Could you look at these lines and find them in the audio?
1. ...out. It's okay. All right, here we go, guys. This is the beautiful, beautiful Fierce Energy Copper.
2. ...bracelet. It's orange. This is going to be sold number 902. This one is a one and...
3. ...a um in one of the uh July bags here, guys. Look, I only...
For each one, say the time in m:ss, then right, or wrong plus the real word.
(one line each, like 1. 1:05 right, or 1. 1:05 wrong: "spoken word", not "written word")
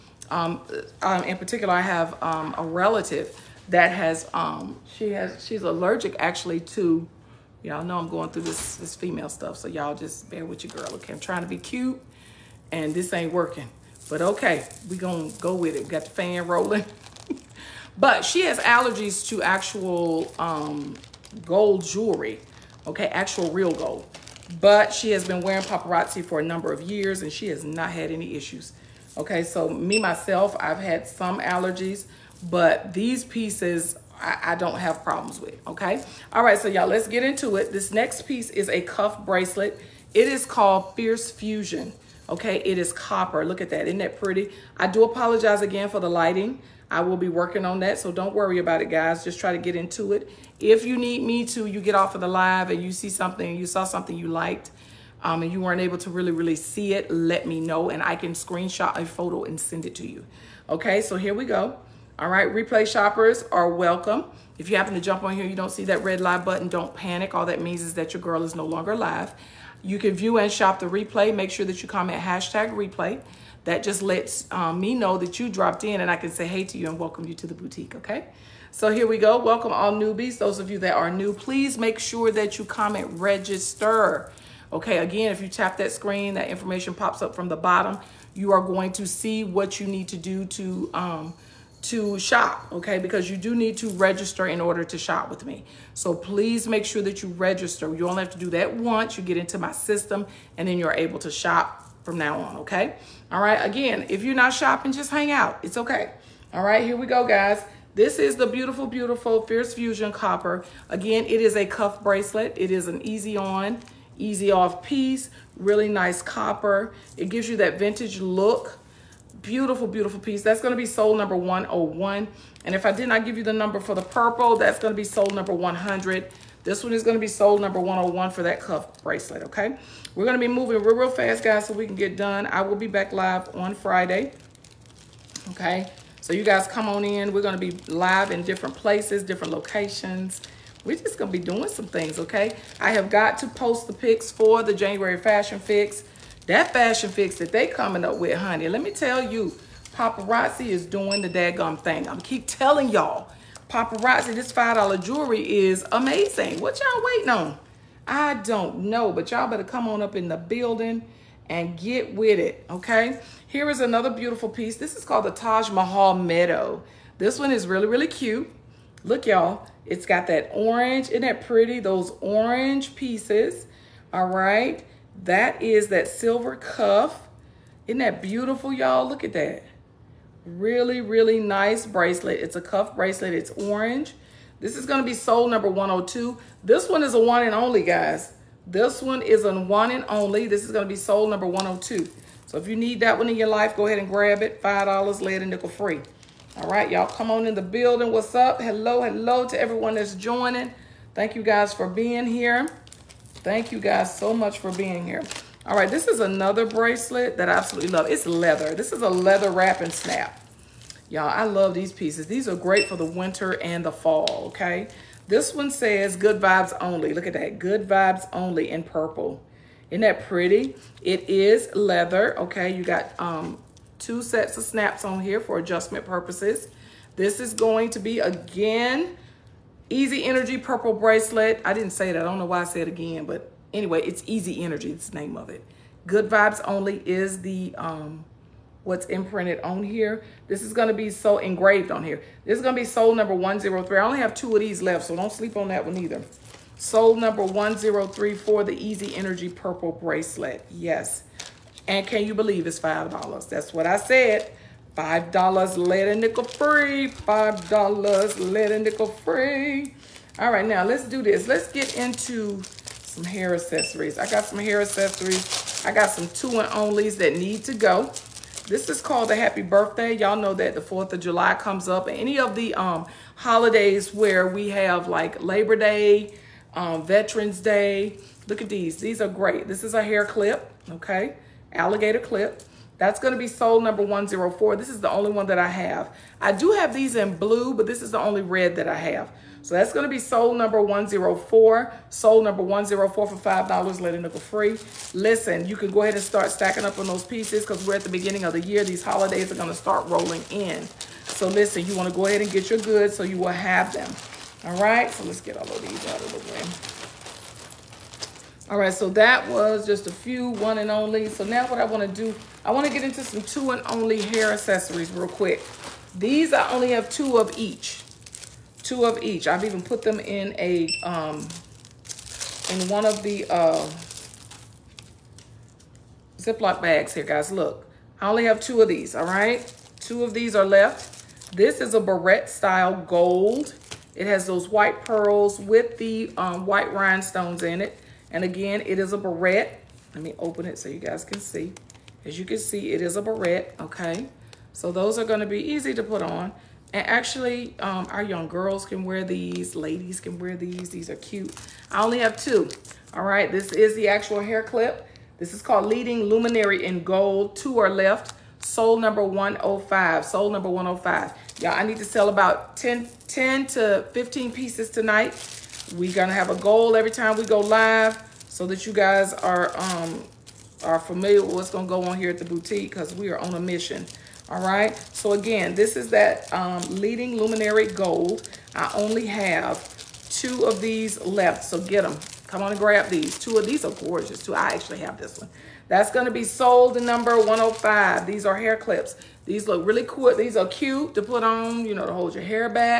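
1. 1:45 wrong: "Fusion", not "Energy"
2. 3:02 wrong: "102", not "902"
3. 5:20 wrong: "Ziploc", not "July".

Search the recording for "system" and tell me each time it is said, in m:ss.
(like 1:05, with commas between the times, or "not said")
1:39.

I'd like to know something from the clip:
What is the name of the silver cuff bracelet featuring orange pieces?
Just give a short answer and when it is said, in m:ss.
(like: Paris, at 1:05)
Taj Mahal Meadow, at 2:45.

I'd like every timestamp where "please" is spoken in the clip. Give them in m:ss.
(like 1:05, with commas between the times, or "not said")
1:21, 1:36.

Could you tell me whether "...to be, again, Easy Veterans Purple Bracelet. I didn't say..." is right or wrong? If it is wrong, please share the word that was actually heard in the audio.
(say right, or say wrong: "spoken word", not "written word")
wrong: "Energy", not "Veterans".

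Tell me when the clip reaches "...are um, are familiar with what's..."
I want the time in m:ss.
6:09.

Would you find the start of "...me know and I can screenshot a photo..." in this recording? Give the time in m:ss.
0:57.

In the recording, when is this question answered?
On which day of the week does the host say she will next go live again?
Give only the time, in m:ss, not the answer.
2:13.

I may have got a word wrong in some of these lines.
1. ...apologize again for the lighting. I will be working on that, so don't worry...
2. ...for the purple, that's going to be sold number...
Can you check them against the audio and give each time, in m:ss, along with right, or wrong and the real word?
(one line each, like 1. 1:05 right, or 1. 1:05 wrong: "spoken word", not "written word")
1. 0:45 right
2. 2:03 right.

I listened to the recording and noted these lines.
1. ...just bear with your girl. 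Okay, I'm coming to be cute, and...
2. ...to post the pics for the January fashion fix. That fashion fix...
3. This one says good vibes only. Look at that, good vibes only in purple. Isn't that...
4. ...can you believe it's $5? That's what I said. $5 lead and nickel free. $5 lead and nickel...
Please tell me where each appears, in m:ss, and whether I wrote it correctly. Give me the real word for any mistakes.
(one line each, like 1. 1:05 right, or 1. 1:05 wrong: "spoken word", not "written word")
1. 0:09 wrong: "trying", not "coming"
2. 2:23 right
3. 3:35 right
4. 4:12 right.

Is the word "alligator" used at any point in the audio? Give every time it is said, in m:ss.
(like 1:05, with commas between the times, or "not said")
4:41.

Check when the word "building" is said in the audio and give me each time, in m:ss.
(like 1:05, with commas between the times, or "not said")
2:40, 3:17.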